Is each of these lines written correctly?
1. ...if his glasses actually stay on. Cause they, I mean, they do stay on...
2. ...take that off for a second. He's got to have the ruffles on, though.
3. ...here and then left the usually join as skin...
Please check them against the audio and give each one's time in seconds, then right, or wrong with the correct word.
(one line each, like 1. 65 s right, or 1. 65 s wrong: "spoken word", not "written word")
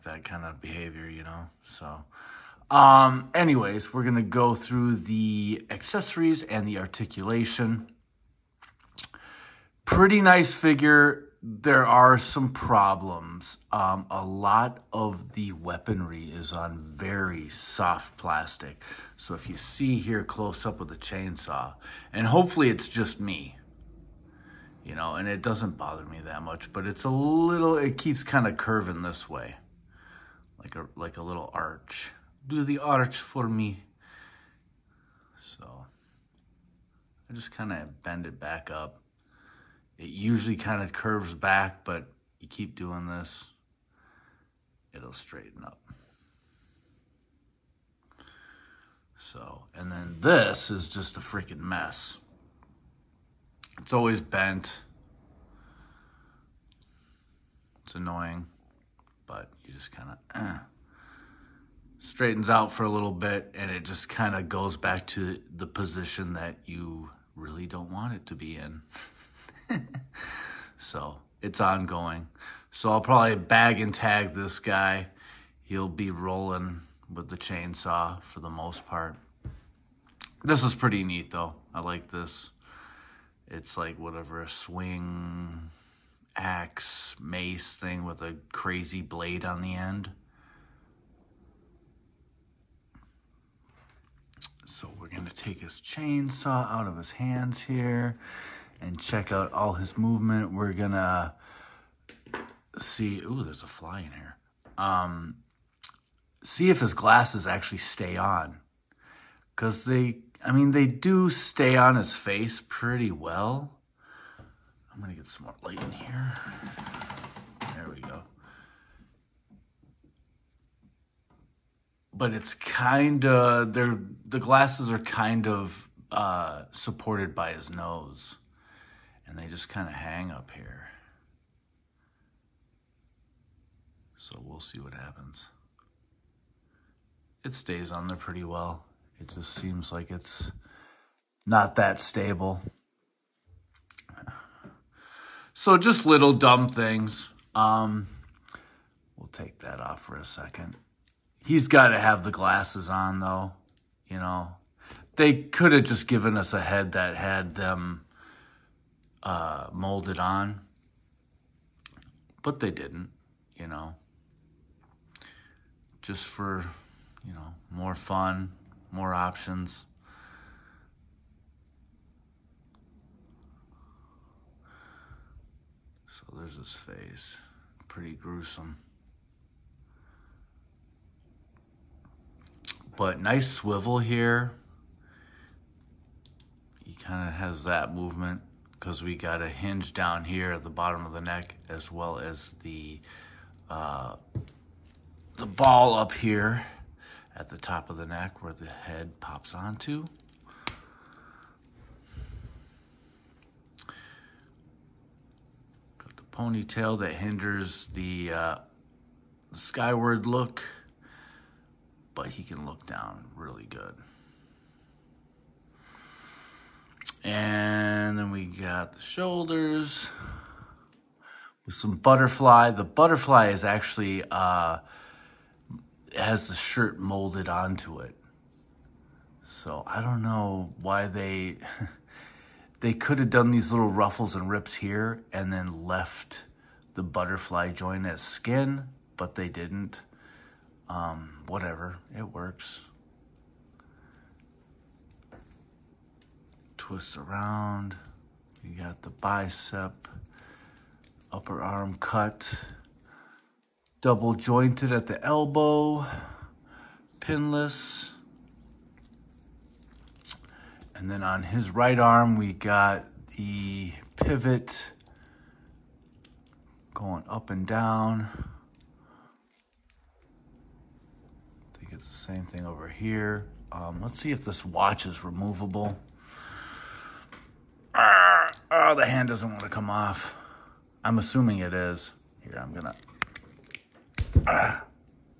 1. 106 s right
2. 149 s wrong: "glasses", not "ruffles"
3. 234 s wrong: "butterfly", not "usually".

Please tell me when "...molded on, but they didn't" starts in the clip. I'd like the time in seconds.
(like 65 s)
159 s.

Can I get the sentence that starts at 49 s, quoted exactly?
So, and then this is just a freaking mess.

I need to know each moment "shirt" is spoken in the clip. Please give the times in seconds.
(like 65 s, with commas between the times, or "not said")
226 s.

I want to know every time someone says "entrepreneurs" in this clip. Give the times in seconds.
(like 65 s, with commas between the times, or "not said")
not said.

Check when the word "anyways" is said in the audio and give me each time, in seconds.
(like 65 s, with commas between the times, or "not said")
3 s.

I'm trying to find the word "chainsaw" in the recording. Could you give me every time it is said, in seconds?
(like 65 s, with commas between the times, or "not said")
20 s, 77 s, 95 s.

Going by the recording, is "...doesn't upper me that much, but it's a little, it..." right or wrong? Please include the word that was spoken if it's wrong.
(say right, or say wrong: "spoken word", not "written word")
wrong: "bother", not "upper".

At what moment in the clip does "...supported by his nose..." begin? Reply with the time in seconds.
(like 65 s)
126 s.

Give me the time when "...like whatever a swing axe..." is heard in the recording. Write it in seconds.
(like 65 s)
83 s.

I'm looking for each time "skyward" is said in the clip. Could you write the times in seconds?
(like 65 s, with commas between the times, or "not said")
209 s.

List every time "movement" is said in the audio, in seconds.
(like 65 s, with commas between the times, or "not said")
99 s, 187 s.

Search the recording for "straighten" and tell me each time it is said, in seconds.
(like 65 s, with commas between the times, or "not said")
45 s, 61 s.